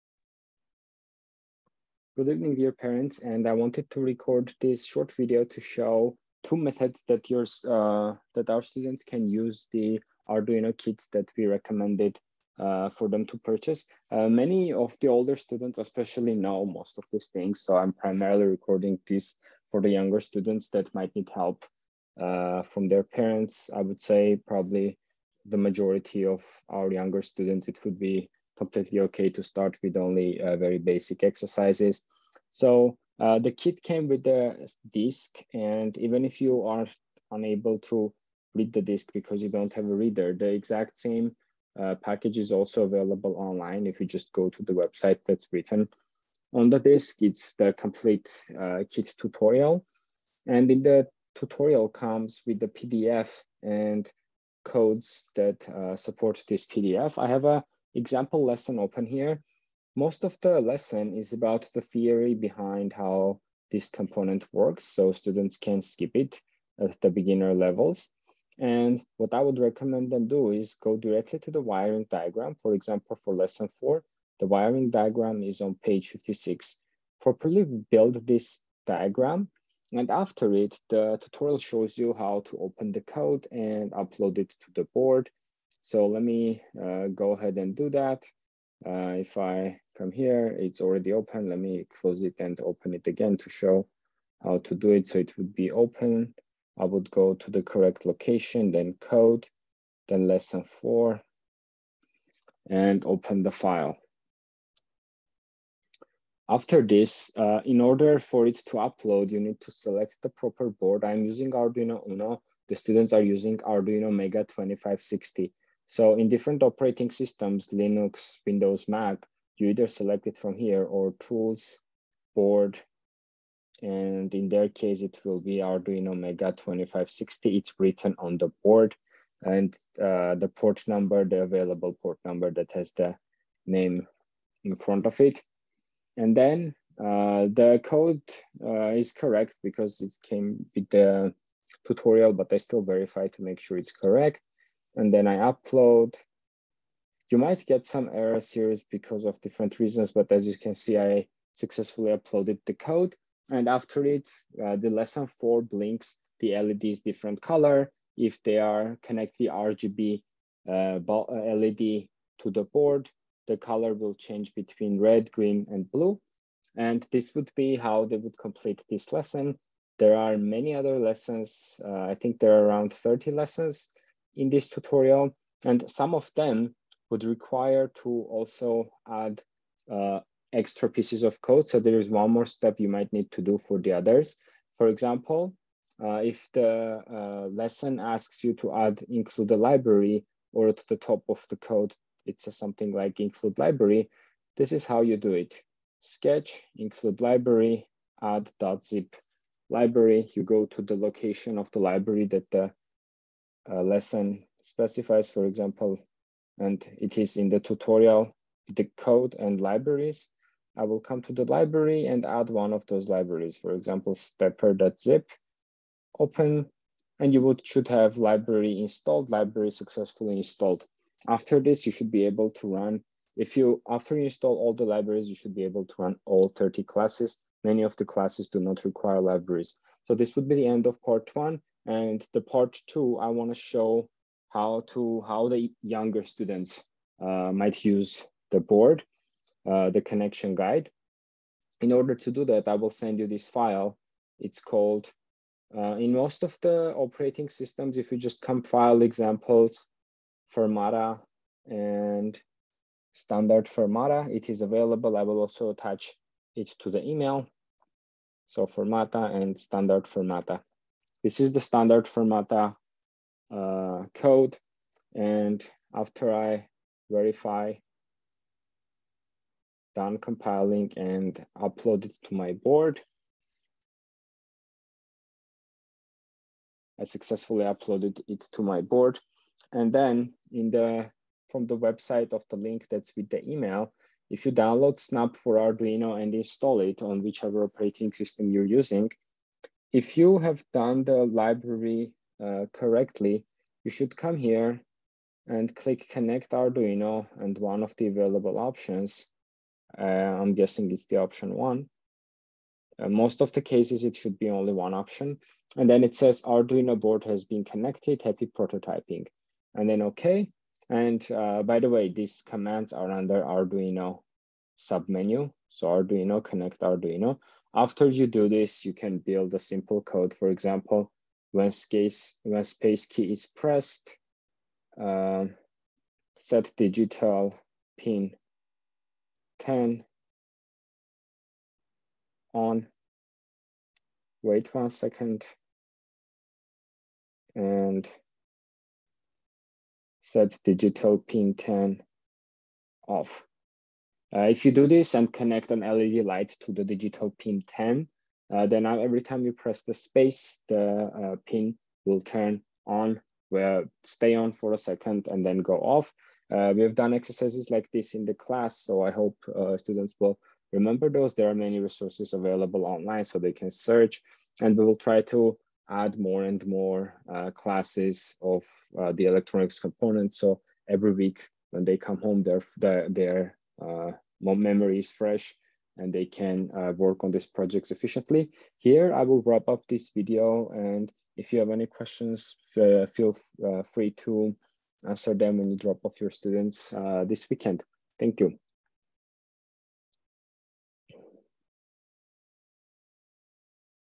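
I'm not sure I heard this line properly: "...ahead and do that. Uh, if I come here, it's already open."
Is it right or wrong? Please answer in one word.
right.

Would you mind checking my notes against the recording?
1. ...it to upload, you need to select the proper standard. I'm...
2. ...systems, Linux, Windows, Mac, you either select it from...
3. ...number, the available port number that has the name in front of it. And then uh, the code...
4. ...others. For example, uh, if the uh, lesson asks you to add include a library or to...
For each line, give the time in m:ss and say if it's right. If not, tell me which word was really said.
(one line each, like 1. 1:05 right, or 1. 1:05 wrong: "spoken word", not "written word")
1. 1:48 wrong: "board", not "standard"
2. 1:57 right
3. 2:10 right
4. 3:03 right.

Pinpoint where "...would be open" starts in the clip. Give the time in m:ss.
1:35.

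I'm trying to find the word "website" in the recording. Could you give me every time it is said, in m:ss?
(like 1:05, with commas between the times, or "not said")
0:44, 4:41.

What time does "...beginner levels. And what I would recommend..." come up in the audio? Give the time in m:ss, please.
1:07.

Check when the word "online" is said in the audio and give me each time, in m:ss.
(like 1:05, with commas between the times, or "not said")
0:43, 6:02.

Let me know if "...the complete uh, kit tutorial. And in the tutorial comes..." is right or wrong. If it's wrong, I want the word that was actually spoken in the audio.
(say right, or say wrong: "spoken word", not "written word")
right.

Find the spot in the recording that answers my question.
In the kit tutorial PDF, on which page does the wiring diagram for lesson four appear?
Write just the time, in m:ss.
1:15.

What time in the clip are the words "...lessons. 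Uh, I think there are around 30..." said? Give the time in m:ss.
2:50.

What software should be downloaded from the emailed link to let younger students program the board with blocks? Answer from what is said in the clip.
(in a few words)
Snap4Arduino.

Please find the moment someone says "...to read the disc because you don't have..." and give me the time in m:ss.
0:37.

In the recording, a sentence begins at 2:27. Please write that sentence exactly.
You might get some errors here because of different reasons, but as you can see, I successfully uploaded the code.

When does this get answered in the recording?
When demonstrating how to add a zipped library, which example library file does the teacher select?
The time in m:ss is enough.
3:34.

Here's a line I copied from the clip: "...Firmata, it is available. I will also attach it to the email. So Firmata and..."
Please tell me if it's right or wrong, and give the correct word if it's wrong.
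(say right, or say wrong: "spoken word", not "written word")
right.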